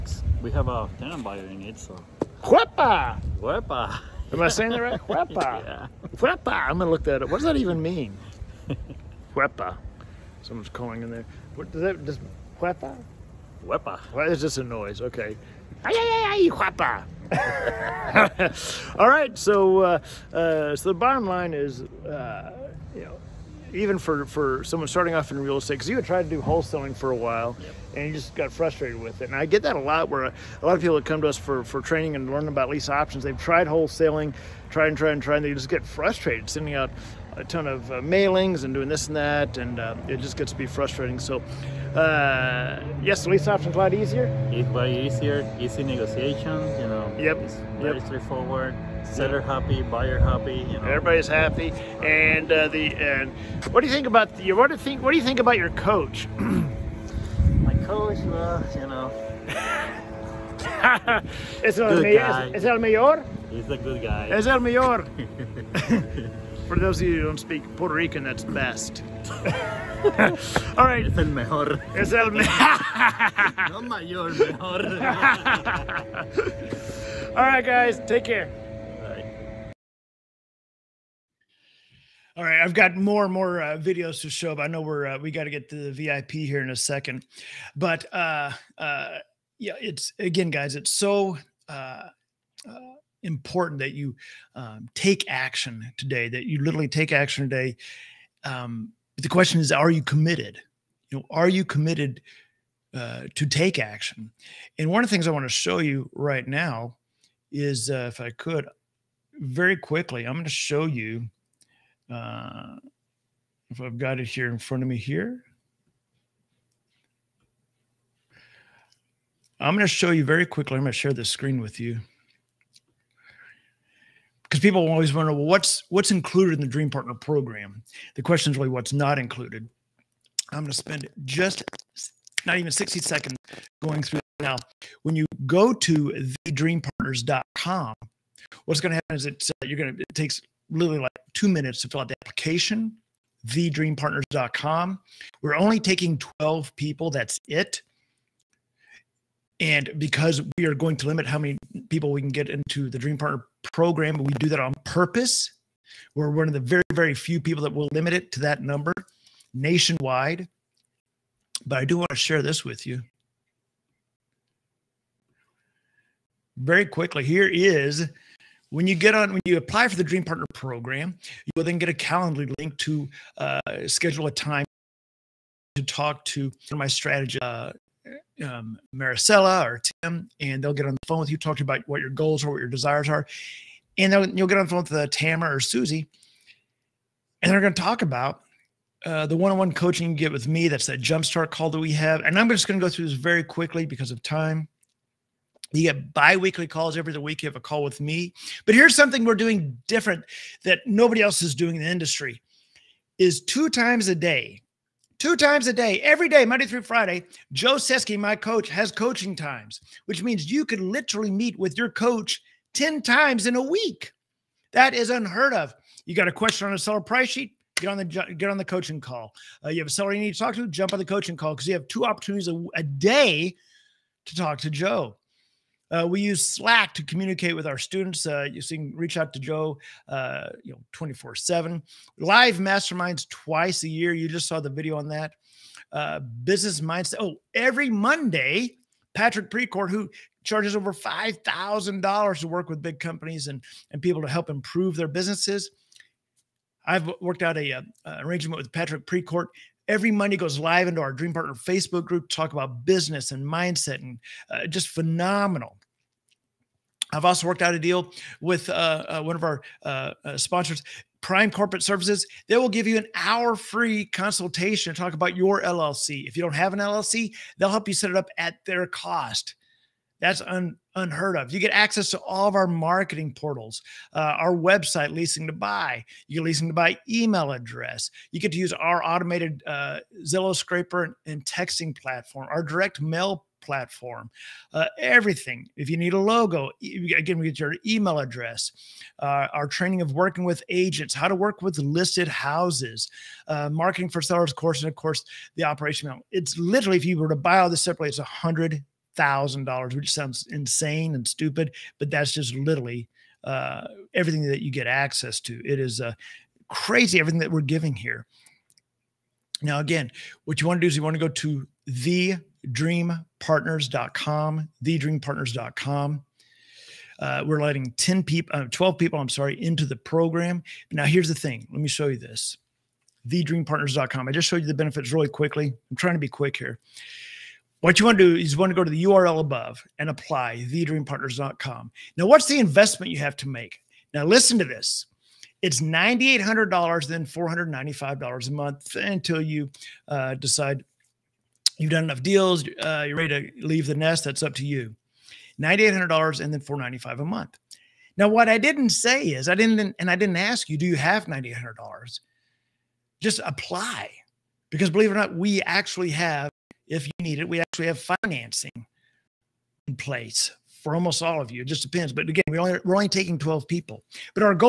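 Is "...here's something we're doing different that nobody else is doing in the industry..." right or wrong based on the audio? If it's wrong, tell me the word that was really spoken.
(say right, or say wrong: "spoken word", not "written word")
right.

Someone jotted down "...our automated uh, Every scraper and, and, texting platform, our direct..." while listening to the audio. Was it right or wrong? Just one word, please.
wrong.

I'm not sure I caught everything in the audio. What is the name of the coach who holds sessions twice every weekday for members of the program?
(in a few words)
Joe Seski.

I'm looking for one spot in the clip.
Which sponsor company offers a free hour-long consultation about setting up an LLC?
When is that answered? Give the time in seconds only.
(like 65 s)
261 s.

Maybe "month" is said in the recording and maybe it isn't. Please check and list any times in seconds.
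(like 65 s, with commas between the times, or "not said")
338 s, 347 s.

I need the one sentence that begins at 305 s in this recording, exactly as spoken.
It is uh, crazy everything that we're giving here.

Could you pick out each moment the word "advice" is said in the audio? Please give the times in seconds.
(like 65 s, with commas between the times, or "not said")
not said.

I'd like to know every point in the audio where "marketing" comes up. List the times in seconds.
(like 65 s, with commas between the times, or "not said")
272 s, 293 s.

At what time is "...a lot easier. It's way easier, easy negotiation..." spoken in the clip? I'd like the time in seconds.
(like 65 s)
43 s.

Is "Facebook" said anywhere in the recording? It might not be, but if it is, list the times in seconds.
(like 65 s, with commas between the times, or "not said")
251 s.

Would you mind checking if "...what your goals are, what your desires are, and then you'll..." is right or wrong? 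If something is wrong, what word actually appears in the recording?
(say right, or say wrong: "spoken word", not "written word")
right.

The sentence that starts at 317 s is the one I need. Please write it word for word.
Uh, we're letting 10 people, uh, 12 people, I'm sorry, into the program.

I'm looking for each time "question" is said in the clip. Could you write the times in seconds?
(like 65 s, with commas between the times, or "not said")
99 s, 128 s, 216 s.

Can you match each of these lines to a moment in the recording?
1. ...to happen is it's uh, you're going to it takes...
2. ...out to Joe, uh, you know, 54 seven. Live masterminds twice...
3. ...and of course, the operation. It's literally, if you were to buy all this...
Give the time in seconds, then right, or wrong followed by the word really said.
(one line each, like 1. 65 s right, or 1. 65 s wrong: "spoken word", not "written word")
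1. 138 s right
2. 229 s wrong: "24", not "54"
3. 294 s right.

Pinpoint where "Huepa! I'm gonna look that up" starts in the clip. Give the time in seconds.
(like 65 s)
6 s.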